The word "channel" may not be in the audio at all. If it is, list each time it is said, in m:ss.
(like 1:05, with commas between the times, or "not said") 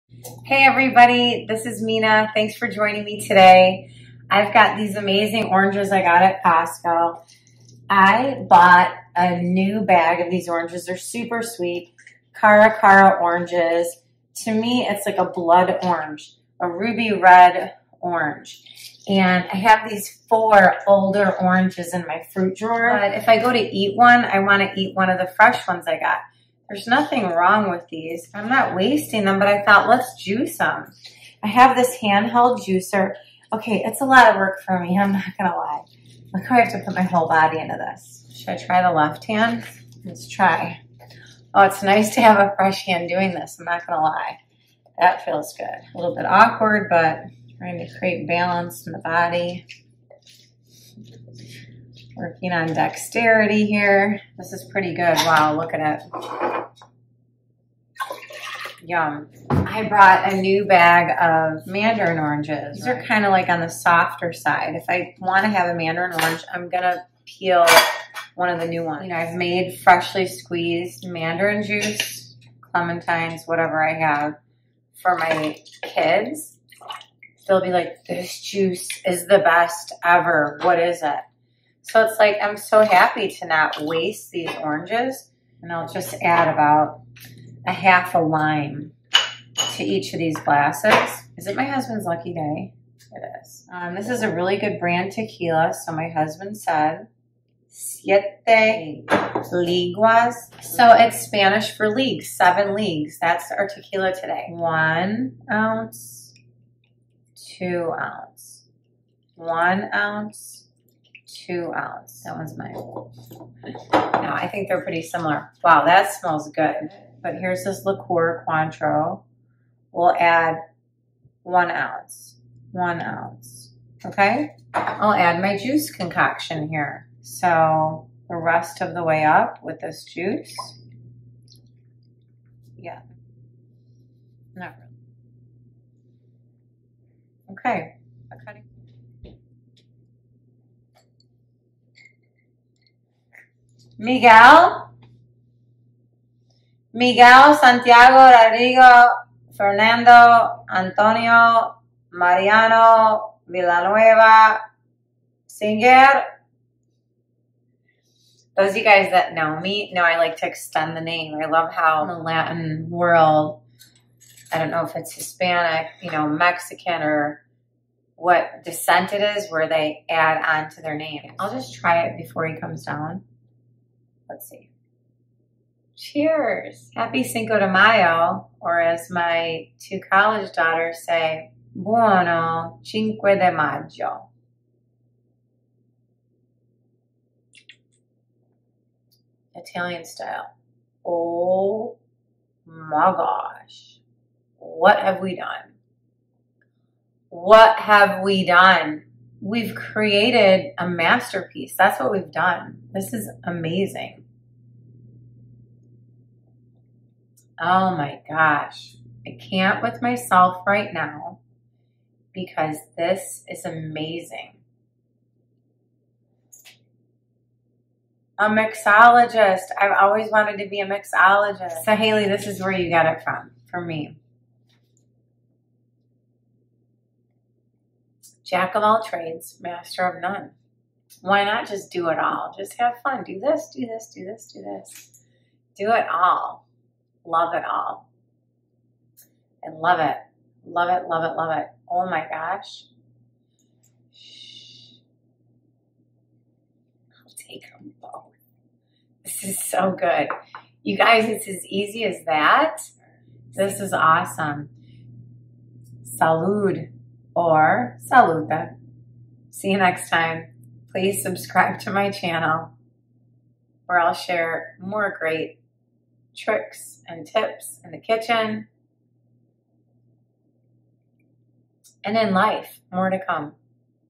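4:22.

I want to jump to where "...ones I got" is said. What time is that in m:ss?
0:25.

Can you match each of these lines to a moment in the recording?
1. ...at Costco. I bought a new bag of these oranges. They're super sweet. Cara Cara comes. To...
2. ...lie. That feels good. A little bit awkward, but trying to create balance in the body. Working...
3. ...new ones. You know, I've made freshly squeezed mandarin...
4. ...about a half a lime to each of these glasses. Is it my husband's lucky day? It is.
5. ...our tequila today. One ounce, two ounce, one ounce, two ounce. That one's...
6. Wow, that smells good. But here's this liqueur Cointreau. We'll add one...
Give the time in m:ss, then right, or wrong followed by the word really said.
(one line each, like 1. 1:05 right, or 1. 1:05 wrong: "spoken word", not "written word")
1. 0:06 wrong: "oranges", not "comes"
2. 0:44 right
3. 1:08 right
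4. 1:26 right
5. 1:43 right
6. 1:55 right.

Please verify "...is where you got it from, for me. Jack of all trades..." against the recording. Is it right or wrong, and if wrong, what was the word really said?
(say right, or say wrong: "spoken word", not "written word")
right.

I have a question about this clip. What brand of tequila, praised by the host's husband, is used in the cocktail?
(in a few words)
Siete Leguas.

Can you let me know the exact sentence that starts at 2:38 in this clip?
Those you guys that know me know I like to extend the name.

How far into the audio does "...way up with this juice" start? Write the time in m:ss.
2:09.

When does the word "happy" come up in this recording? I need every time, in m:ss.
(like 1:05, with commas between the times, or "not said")
1:22, 2:56.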